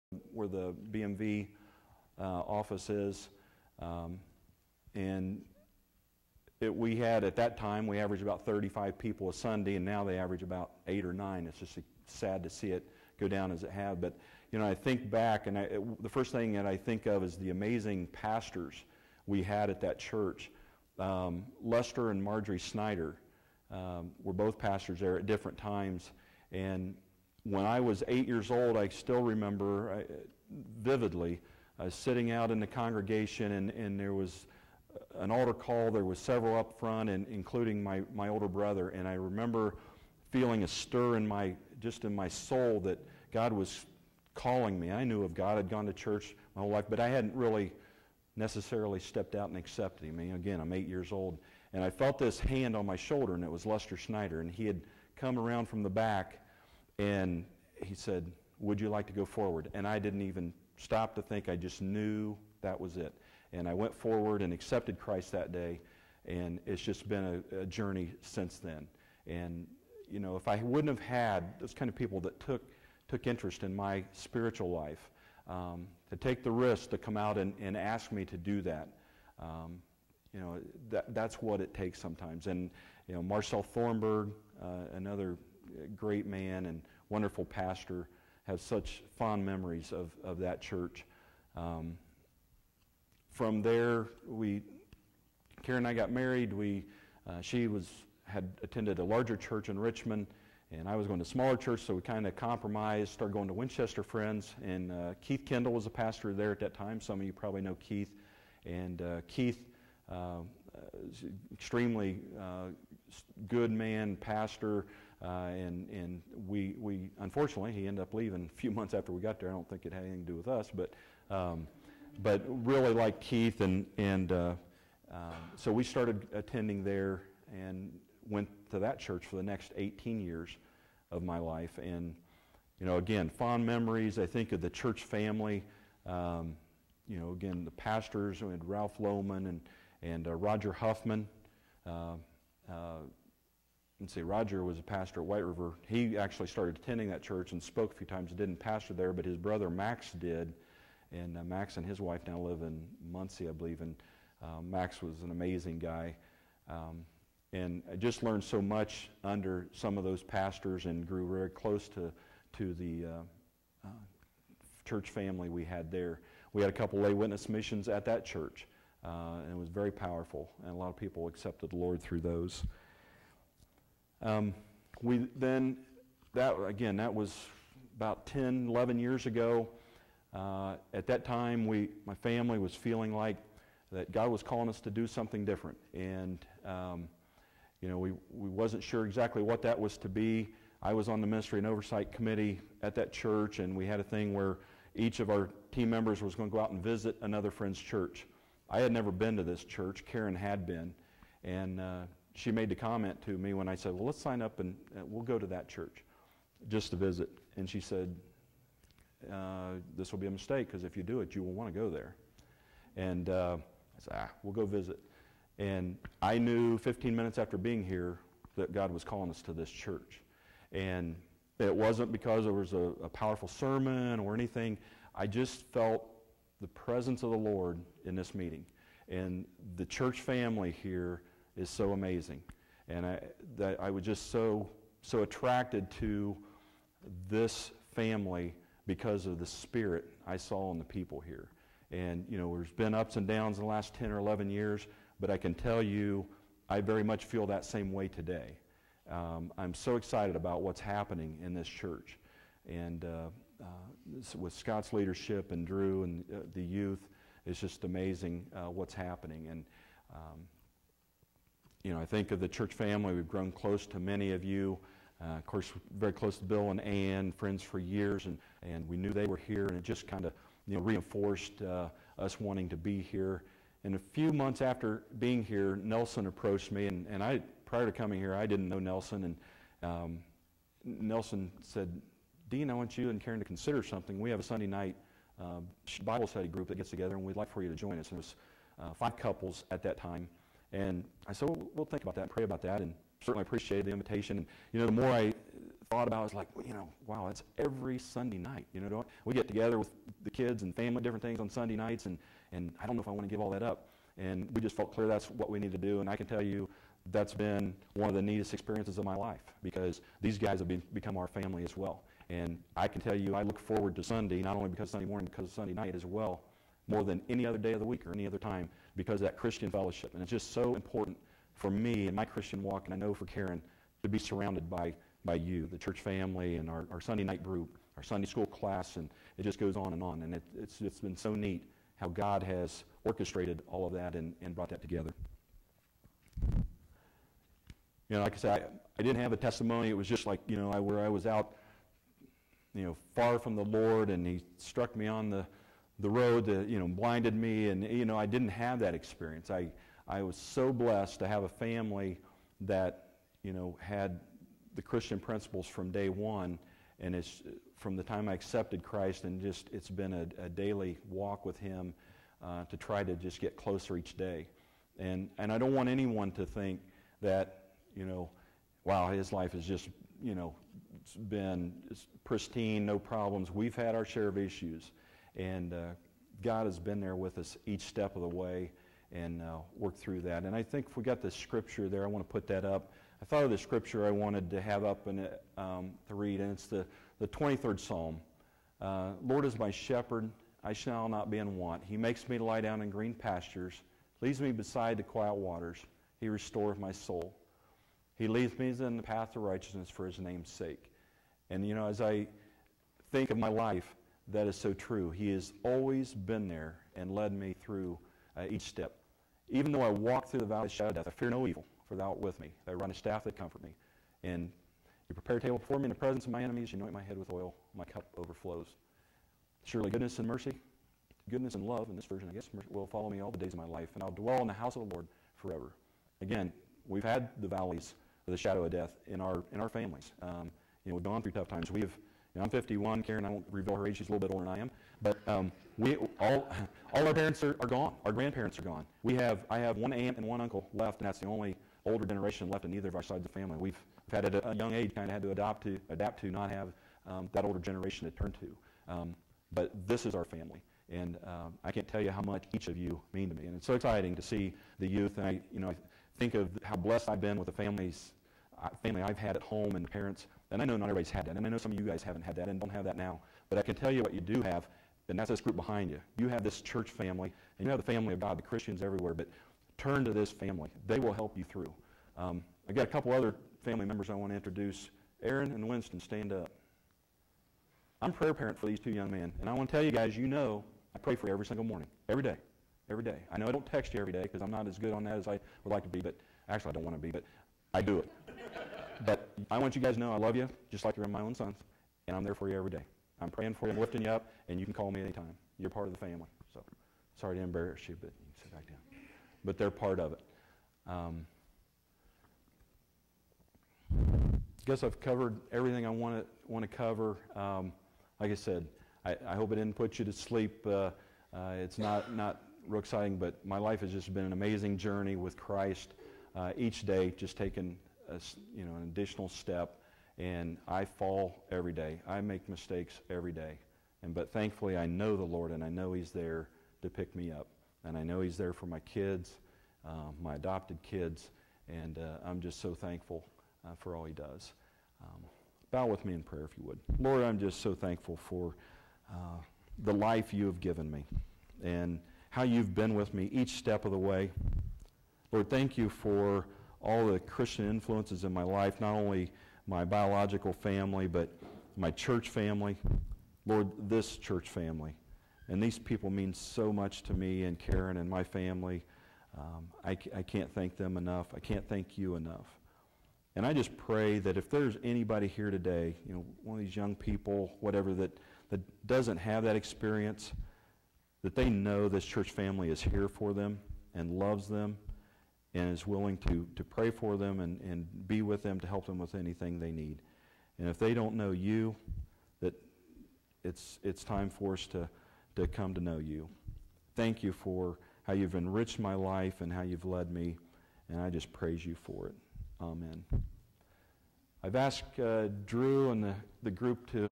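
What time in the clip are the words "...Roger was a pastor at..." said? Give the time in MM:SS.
02:24.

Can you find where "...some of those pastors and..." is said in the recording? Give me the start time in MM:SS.
02:39.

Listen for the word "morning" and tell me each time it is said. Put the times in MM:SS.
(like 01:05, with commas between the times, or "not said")
05:15, 08:01.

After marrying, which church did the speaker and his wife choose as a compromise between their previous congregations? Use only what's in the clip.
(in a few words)
Winchester Friends.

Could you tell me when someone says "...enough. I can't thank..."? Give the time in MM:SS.
09:20.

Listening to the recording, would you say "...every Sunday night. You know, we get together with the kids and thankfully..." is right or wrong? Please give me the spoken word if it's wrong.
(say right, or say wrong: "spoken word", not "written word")
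wrong: "family", not "thankfully".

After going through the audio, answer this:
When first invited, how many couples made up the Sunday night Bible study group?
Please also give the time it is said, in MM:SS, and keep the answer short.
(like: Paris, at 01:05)
5, at 04:48.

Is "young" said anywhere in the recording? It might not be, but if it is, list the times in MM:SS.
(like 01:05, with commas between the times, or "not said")
07:24, 07:58, 09:26.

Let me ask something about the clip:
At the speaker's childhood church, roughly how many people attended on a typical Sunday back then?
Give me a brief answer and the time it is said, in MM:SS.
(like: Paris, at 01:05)
35, at 00:08.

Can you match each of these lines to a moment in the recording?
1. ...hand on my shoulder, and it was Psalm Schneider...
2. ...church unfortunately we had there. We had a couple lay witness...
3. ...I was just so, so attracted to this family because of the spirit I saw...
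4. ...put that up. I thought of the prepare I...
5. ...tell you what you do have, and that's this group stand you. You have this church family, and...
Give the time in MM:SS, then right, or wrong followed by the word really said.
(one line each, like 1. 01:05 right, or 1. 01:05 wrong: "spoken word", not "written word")
1. 00:52 wrong: "Lester", not "Psalm"
2. 02:44 wrong: "family", not "unfortunately"
3. 03:53 right
4. 06:22 wrong: "scripture", not "prepare"
5. 07:43 wrong: "behind", not "stand".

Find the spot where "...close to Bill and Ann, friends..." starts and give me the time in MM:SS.
04:26.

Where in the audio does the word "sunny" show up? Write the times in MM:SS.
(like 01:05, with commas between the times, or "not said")
not said.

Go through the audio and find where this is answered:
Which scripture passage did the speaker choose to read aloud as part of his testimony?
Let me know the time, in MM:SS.
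06:27.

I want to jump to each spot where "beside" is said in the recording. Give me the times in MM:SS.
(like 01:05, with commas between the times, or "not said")
06:34.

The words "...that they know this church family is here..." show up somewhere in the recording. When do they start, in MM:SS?
09:31.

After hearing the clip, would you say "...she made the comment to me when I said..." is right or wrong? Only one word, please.
right.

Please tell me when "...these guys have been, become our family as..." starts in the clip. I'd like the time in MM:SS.
05:10.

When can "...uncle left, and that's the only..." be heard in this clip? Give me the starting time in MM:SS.
07:20.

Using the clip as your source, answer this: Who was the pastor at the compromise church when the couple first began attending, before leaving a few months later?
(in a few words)
Keith Kendall.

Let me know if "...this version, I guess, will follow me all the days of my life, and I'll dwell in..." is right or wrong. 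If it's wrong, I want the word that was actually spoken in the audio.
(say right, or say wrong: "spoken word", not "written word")
right.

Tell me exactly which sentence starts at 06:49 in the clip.
Even though I walk through the valley of the shadow of death, I fear no evil, for thou art with me.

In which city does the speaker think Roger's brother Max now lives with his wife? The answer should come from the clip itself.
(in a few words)
Muncie.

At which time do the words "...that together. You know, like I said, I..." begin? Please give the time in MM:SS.
05:34.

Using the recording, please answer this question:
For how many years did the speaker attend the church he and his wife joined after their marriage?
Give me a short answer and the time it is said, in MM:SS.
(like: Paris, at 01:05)
18, at 02:09.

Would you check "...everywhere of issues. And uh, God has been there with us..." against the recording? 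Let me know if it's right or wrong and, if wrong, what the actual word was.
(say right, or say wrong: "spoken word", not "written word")
wrong: "share", not "everywhere".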